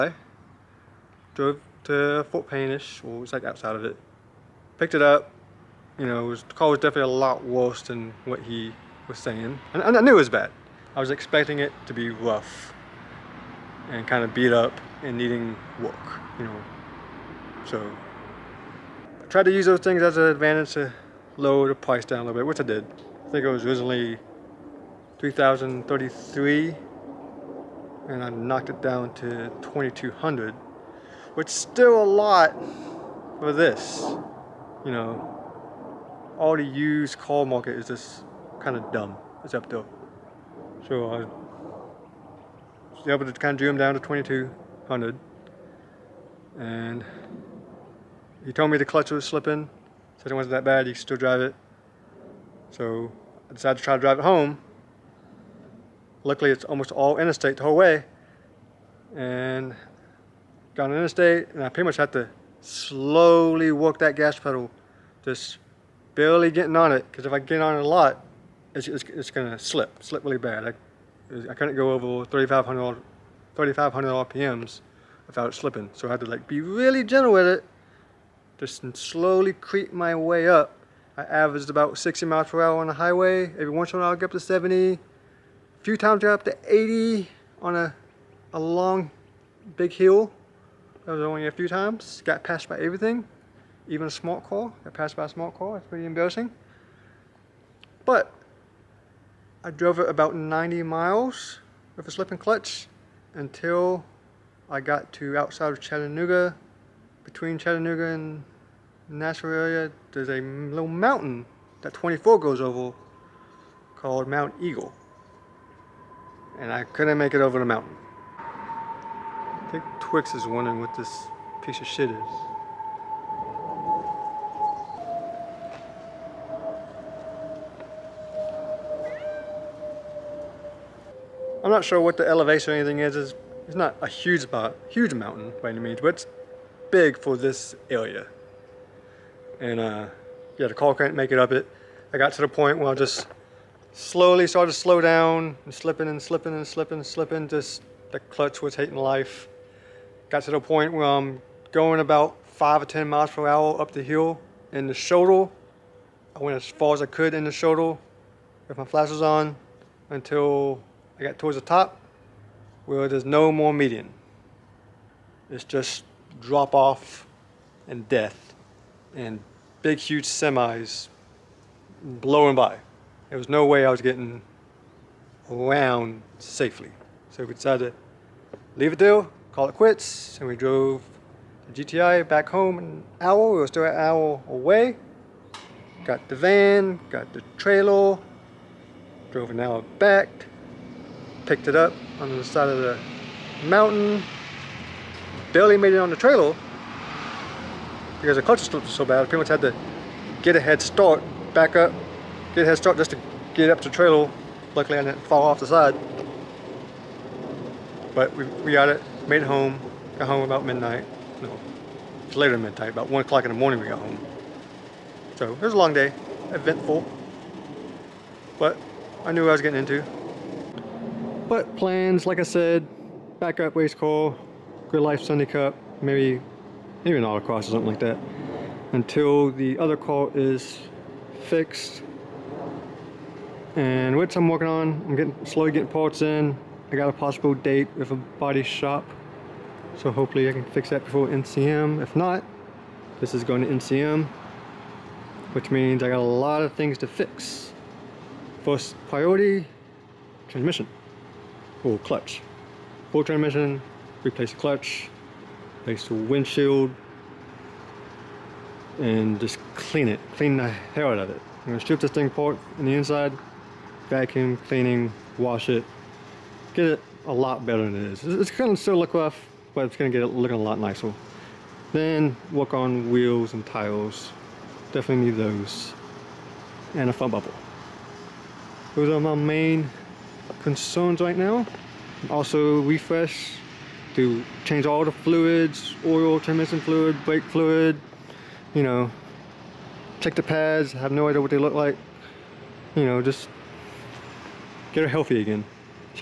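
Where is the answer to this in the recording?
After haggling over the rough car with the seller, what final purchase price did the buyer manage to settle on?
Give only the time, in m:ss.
0:29.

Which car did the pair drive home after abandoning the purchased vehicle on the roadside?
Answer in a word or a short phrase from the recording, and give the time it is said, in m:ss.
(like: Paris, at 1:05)
GTI, at 3:01.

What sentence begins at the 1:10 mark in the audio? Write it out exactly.
I, I couldn't go over 3,500 3,500 RPMs without slipping.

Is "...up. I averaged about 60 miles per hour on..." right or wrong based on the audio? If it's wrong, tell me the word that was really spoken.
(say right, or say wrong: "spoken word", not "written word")
right.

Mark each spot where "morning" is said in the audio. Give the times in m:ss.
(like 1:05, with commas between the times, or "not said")
3:33.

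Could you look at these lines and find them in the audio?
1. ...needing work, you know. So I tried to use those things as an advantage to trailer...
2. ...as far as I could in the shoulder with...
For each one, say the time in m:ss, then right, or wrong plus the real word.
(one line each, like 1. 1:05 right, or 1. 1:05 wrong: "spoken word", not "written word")
1. 0:15 wrong: "lower", not "trailer"
2. 2:36 right.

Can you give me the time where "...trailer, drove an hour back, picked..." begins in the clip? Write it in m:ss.
3:07.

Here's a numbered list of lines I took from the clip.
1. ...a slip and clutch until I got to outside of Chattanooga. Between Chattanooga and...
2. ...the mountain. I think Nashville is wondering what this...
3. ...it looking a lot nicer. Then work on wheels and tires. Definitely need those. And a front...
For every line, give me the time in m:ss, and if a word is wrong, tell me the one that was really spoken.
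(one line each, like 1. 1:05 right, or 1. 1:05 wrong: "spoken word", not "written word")
1. 1:42 right
2. 1:57 wrong: "Twix", not "Nashville"
3. 4:30 right.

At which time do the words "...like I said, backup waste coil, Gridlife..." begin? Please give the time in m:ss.
3:42.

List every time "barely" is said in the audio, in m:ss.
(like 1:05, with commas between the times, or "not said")
1:06, 3:15.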